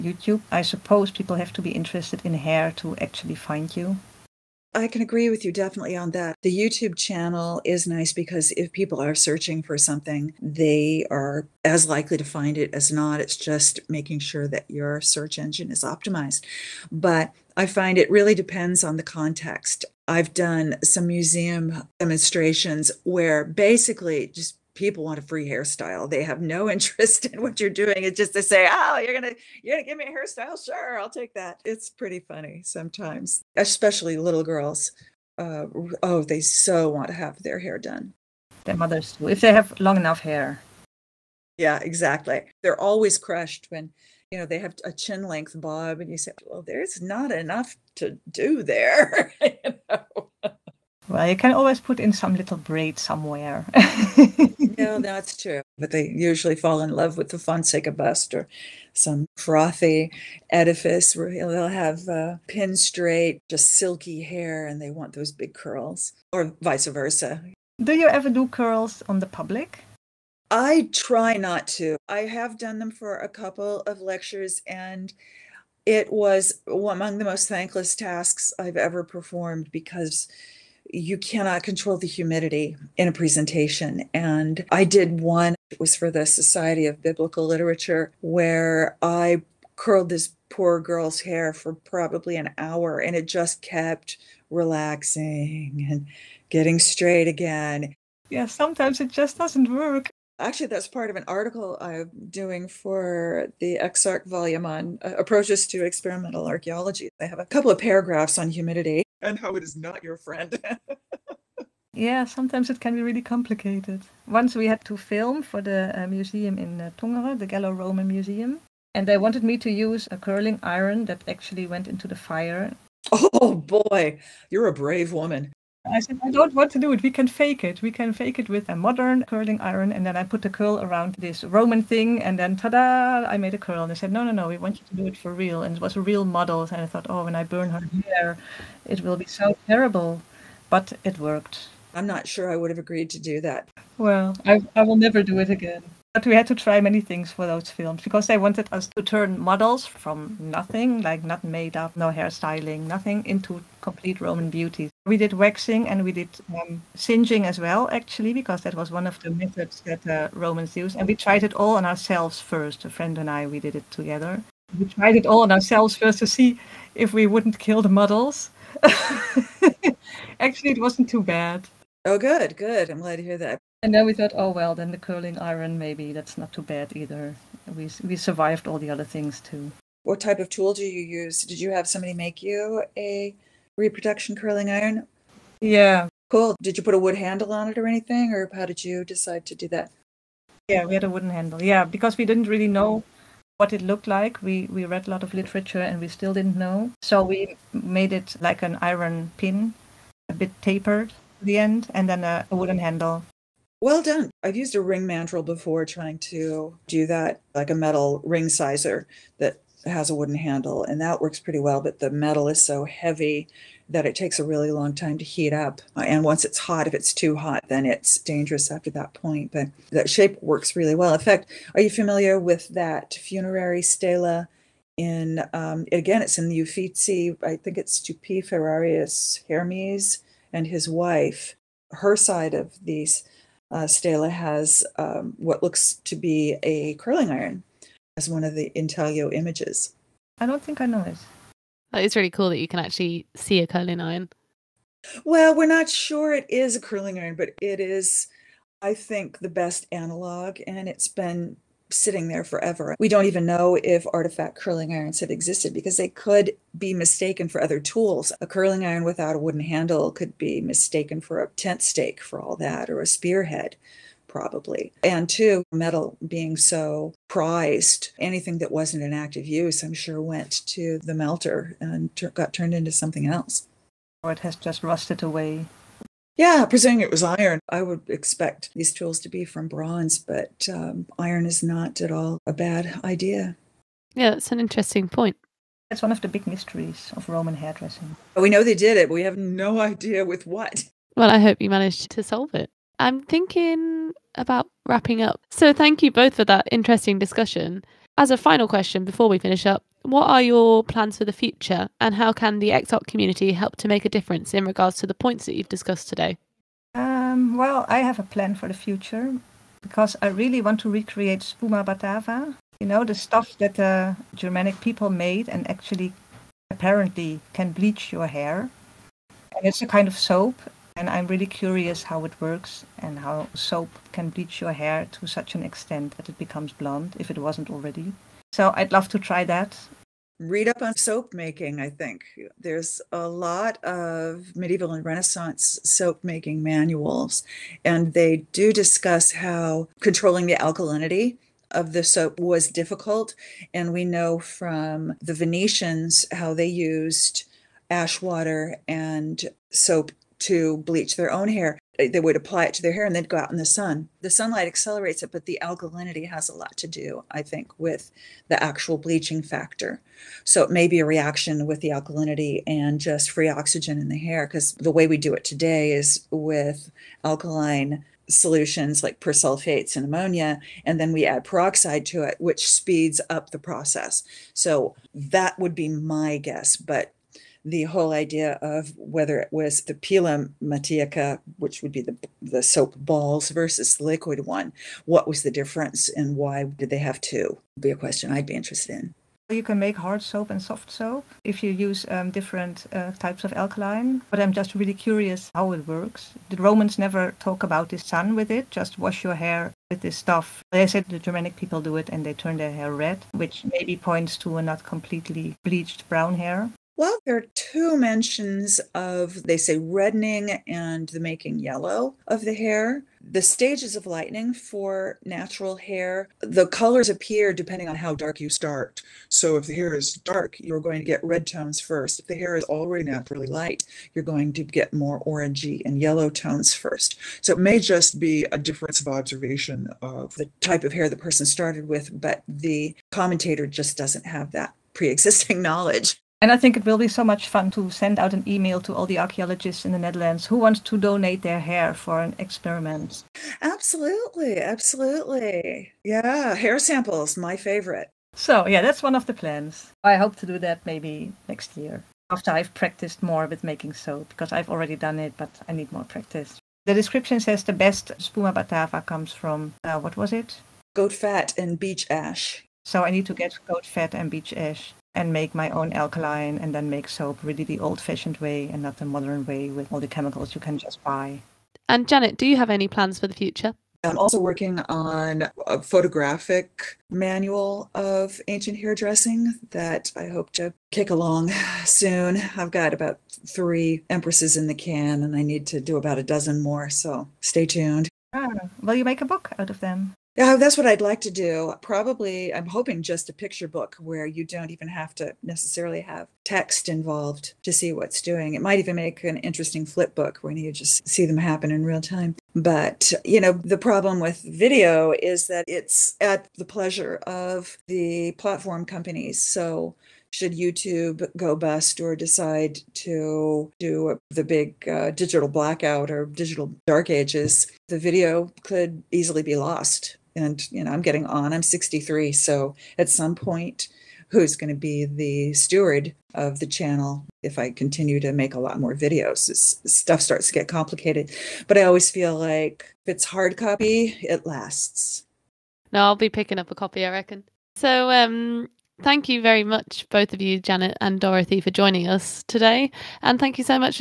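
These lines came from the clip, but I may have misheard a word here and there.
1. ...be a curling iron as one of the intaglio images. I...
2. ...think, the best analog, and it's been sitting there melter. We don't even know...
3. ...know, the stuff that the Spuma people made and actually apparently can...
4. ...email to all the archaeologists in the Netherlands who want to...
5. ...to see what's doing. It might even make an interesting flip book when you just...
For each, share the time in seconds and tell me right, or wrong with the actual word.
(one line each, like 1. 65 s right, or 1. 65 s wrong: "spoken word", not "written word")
1. 236 s right
2. 248 s wrong: "forever", not "melter"
3. 312 s wrong: "Germanic", not "Spuma"
4. 438 s right
5. 497 s right.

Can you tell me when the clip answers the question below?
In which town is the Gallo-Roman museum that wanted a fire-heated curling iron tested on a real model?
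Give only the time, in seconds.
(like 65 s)
116 s.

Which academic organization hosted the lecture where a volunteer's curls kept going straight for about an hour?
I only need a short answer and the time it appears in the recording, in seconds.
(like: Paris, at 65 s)
Society of Biblical Literature, at 86 s.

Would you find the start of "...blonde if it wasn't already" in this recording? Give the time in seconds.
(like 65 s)
326 s.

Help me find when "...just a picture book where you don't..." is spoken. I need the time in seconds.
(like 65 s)
493 s.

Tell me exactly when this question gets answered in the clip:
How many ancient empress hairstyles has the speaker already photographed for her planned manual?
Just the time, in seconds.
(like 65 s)
483 s.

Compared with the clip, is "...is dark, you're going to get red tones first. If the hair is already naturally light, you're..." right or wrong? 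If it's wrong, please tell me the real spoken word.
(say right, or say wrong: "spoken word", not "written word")
right.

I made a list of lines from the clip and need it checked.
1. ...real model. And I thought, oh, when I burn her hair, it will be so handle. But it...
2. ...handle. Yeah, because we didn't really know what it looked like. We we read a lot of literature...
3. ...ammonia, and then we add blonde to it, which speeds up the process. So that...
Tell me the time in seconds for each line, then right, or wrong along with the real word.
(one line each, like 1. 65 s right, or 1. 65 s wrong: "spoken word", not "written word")
1. 135 s wrong: "terrible", not "handle"
2. 191 s right
3. 370 s wrong: "peroxide", not "blonde".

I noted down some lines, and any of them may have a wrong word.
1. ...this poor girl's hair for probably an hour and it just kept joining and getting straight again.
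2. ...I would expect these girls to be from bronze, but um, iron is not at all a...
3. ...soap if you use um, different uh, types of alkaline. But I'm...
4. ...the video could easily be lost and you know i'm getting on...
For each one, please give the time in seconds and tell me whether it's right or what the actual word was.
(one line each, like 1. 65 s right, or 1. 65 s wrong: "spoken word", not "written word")
1. 90 s wrong: "relaxing", not "joining"
2. 277 s wrong: "tools", not "girls"
3. 390 s right
4. 517 s right.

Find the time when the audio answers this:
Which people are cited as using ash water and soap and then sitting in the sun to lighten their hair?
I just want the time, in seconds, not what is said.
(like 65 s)
345 s.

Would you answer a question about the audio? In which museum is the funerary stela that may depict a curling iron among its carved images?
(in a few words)
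Uffizi.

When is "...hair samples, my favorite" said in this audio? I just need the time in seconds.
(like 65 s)
446 s.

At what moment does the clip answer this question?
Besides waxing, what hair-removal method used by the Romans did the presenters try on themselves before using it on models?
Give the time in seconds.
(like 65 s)
156 s.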